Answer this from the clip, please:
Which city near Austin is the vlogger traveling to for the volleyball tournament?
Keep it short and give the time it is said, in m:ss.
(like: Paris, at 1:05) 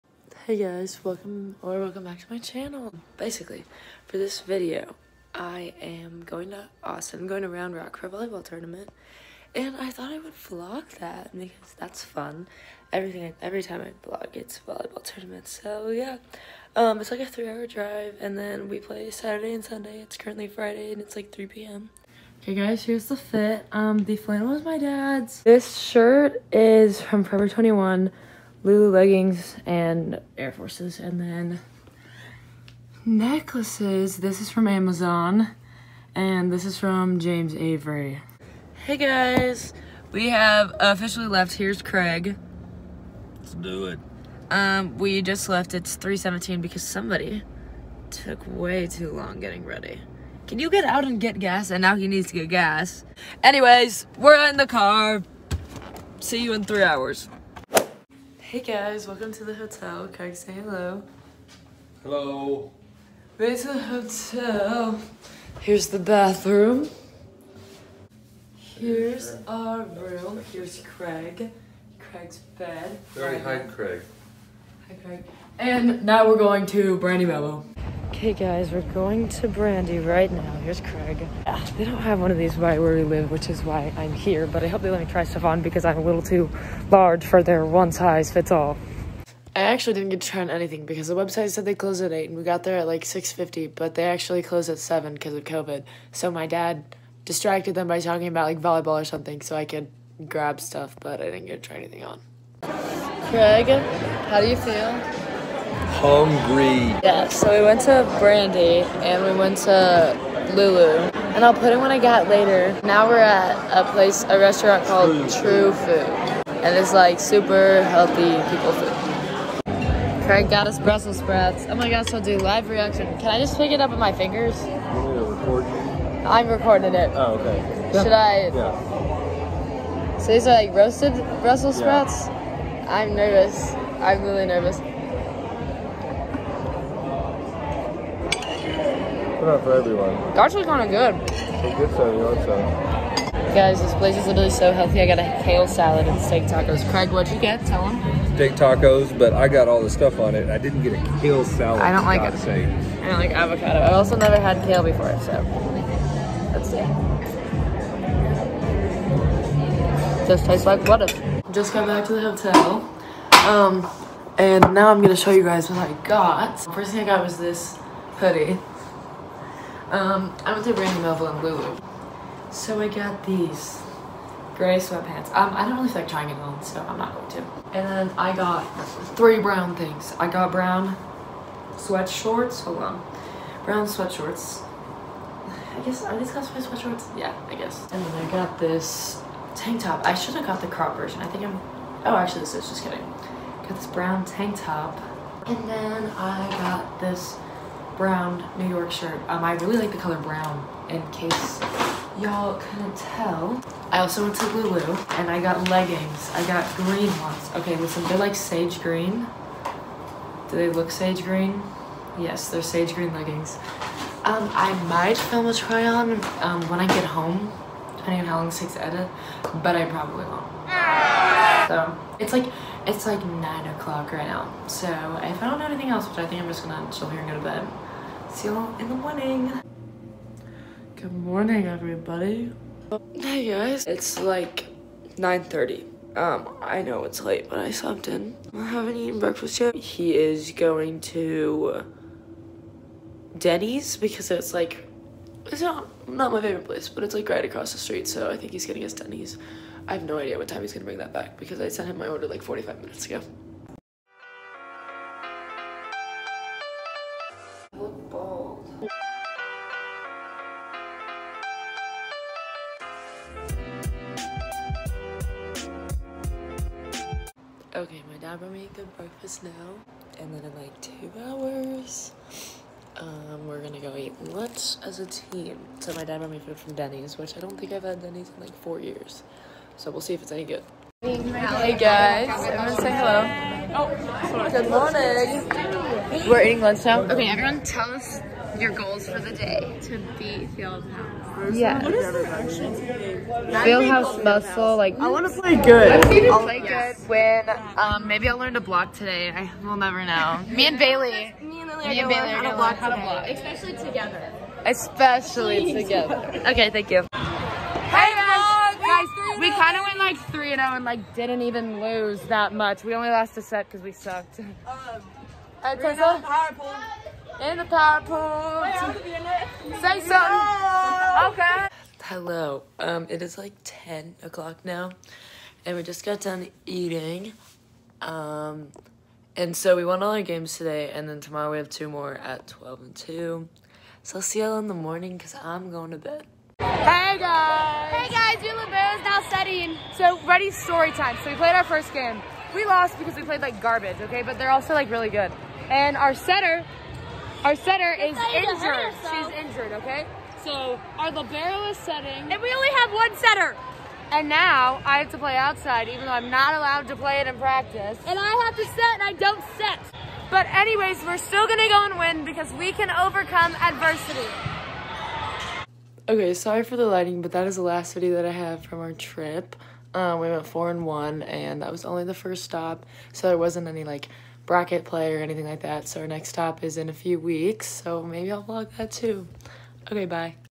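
Round Rock, at 0:07.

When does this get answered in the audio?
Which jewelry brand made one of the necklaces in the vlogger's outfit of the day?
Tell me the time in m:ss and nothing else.
0:37.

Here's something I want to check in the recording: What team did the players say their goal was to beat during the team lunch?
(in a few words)
Field House.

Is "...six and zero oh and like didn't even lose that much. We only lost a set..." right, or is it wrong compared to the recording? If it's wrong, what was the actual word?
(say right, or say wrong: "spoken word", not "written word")
wrong: "three", not "six".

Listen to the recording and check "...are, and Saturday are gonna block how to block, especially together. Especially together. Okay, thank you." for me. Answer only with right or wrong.
wrong.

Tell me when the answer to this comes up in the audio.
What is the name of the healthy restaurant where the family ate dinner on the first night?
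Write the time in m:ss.
1:55.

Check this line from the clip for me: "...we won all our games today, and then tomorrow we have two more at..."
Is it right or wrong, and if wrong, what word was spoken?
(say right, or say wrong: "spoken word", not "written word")
right.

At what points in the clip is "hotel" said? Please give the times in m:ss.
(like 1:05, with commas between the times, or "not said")
0:59, 1:03, 2:42.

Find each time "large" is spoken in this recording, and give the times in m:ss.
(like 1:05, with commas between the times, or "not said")
1:26.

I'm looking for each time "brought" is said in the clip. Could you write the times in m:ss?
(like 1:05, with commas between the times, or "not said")
4:28, 4:36.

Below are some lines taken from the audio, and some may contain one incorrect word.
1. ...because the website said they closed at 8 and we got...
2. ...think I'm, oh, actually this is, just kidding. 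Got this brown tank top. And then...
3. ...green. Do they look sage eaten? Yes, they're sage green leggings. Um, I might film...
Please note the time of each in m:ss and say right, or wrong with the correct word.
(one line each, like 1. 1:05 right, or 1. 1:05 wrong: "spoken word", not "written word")
1. 1:30 right
2. 3:11 right
3. 3:28 wrong: "green", not "eaten".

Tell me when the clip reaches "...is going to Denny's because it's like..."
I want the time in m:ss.
4:00.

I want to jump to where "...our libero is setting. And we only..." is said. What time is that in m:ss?
5:50.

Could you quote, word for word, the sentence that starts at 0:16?
Um, it's like a three-hour drive, and then we play Saturday and Sunday.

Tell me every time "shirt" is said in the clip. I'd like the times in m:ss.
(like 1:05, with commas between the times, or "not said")
0:25, 3:18.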